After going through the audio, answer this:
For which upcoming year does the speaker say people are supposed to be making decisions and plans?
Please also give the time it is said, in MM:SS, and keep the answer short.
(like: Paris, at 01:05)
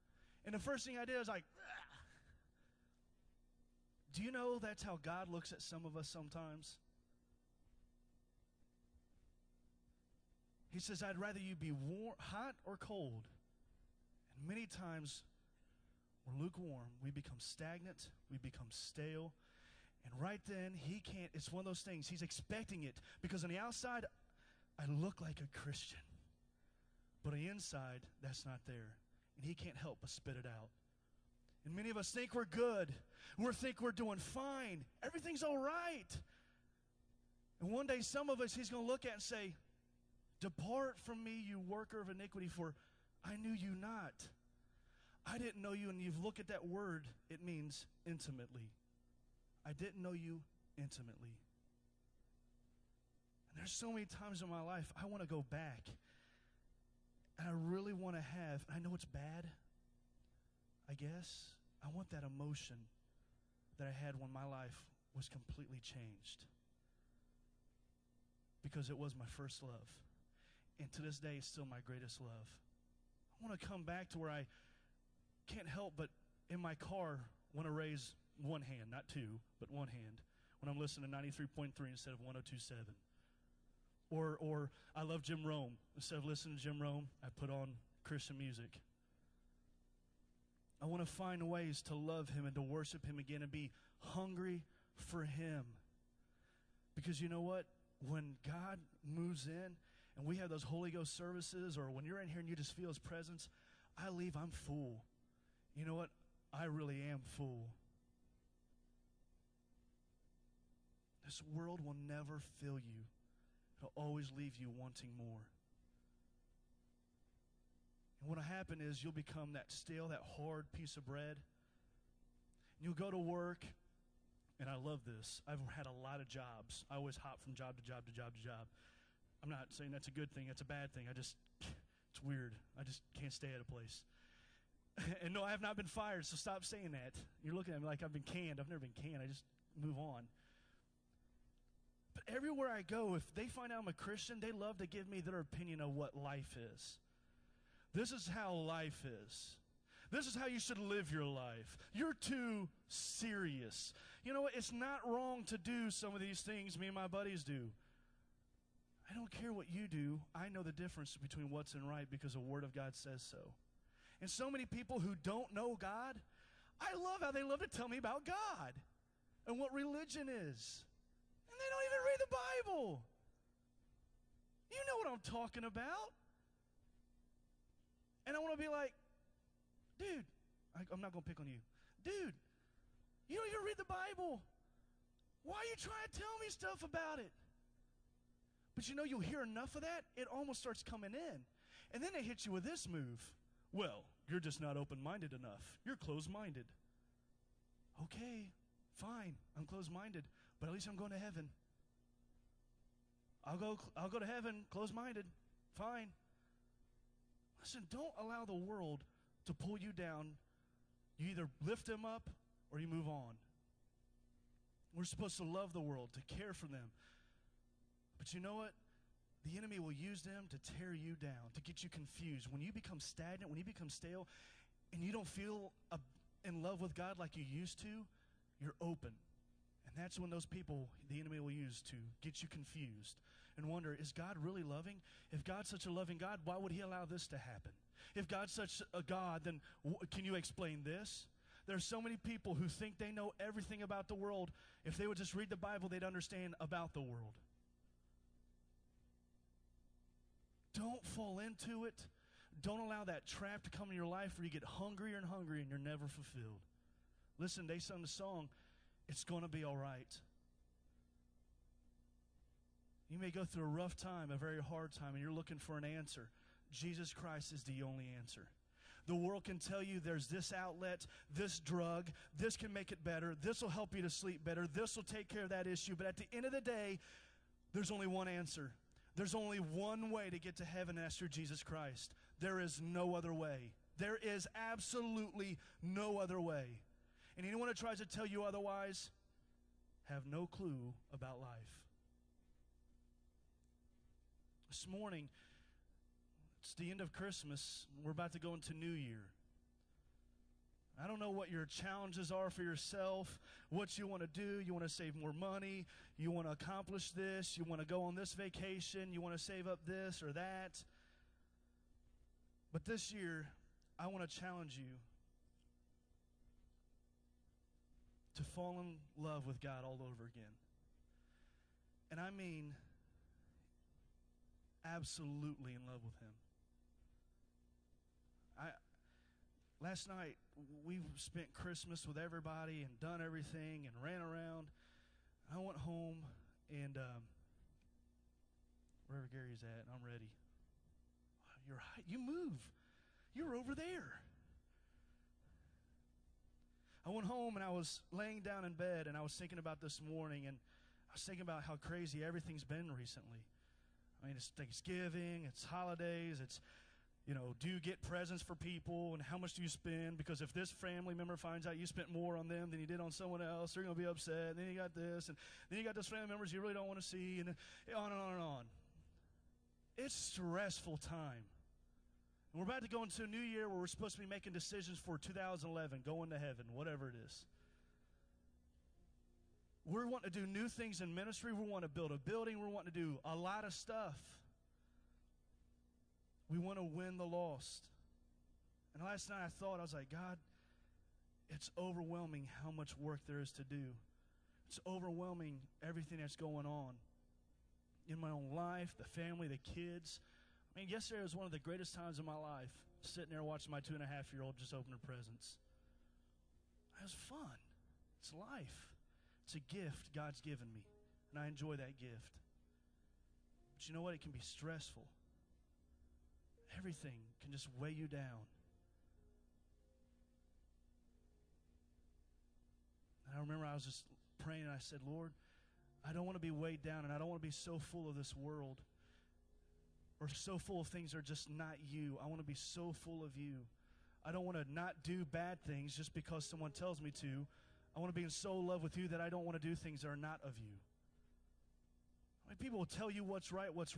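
2011, at 06:15.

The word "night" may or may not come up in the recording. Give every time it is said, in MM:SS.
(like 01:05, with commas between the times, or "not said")
05:30, 06:29.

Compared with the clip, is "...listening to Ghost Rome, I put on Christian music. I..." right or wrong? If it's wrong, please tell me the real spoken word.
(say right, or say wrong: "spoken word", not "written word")
wrong: "Jim", not "Ghost".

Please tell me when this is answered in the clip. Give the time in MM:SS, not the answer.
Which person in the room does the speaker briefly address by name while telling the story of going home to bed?
05:39.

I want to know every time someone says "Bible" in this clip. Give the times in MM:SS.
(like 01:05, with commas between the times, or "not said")
02:52, 03:03, 04:05.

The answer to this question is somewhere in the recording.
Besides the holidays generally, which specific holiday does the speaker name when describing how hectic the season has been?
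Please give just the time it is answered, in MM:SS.
05:54.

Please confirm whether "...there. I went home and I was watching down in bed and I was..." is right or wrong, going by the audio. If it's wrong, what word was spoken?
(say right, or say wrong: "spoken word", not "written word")
wrong: "laying", not "watching".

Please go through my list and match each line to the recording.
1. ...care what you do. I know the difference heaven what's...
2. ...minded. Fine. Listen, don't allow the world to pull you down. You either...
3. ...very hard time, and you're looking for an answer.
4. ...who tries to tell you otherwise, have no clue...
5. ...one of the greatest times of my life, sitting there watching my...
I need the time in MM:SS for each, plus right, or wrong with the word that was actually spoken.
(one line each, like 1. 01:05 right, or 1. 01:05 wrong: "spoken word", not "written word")
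1. 02:39 wrong: "between", not "heaven"
2. 03:24 right
3. 04:24 right
4. 04:47 right
5. 06:41 right.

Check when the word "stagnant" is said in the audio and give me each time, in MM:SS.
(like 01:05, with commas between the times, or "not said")
00:17, 03:42.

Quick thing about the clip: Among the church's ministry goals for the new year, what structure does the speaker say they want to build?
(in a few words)
a building.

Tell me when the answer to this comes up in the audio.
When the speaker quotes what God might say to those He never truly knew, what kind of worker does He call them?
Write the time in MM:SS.
00:41.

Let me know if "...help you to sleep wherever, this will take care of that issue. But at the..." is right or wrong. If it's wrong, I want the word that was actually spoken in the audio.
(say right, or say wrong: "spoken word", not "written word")
wrong: "better", not "wherever".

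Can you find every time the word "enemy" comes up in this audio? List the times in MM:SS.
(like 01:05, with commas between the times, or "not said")
03:39, 03:51.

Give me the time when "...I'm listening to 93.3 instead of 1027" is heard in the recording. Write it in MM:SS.
01:20.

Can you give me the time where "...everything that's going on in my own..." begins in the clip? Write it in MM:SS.
06:35.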